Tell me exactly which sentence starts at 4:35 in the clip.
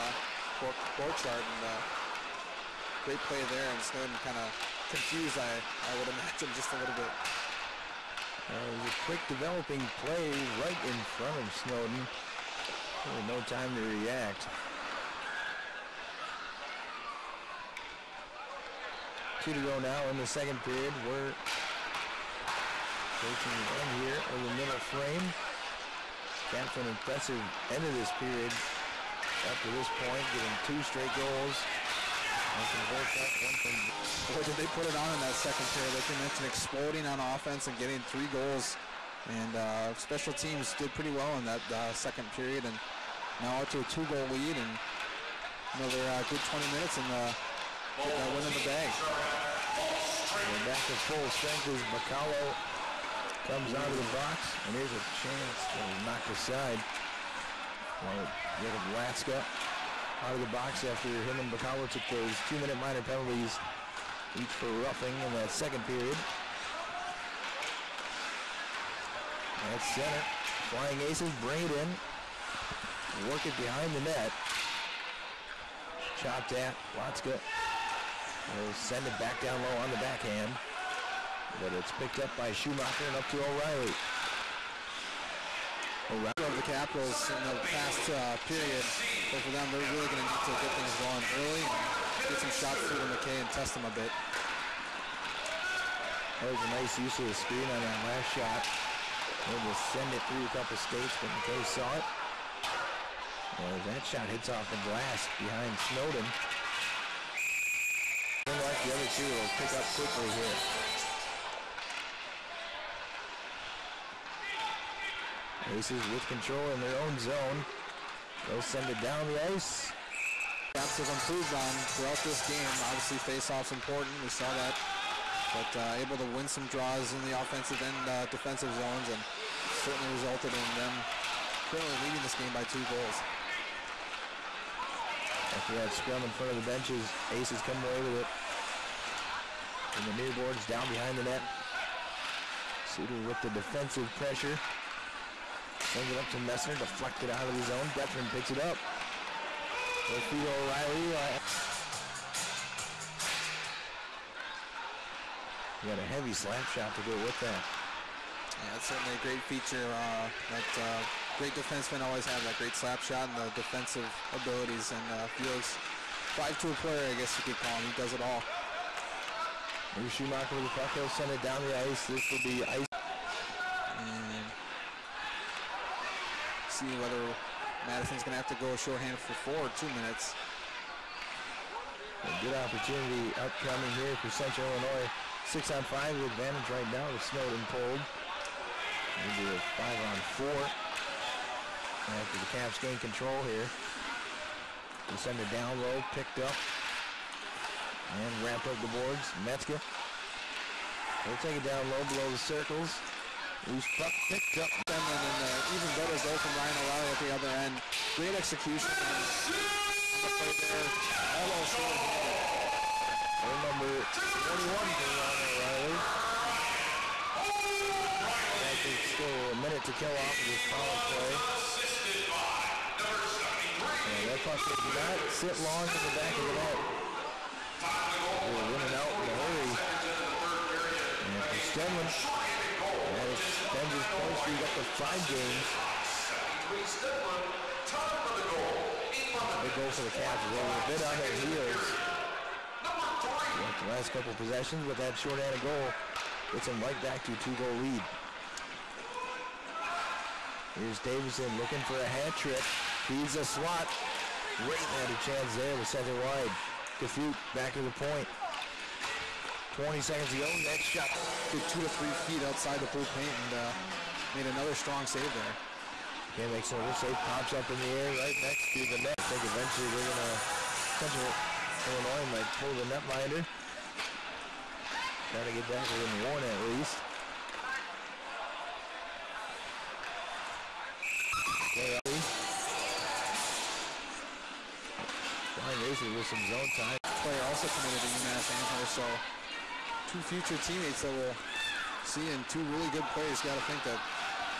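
Trying to get back within one at least.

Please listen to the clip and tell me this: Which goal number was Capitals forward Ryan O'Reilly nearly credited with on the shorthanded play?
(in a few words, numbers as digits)
21.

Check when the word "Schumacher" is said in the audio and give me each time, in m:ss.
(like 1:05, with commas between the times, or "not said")
1:22, 2:50.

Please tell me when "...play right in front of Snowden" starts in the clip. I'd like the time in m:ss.
0:10.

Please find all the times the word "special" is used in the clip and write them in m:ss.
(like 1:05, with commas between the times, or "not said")
0:39.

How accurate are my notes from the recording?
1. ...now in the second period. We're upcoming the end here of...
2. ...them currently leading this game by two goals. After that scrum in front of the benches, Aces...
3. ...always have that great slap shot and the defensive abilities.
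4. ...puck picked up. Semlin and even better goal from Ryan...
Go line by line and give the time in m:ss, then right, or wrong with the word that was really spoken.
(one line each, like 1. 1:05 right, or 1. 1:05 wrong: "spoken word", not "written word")
1. 0:19 wrong: "approaching", not "upcoming"
2. 2:10 right
3. 2:41 right
4. 3:23 right.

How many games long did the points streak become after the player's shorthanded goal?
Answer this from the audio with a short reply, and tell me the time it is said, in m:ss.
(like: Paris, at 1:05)
5, at 3:54.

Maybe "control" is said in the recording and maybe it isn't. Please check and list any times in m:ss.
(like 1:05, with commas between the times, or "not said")
1:56, 3:12.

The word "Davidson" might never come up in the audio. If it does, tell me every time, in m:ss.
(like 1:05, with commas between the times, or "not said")
4:10.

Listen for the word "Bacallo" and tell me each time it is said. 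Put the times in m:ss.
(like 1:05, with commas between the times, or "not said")
0:51, 1:01.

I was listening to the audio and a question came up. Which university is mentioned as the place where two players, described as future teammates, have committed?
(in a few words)
UMass Amherst.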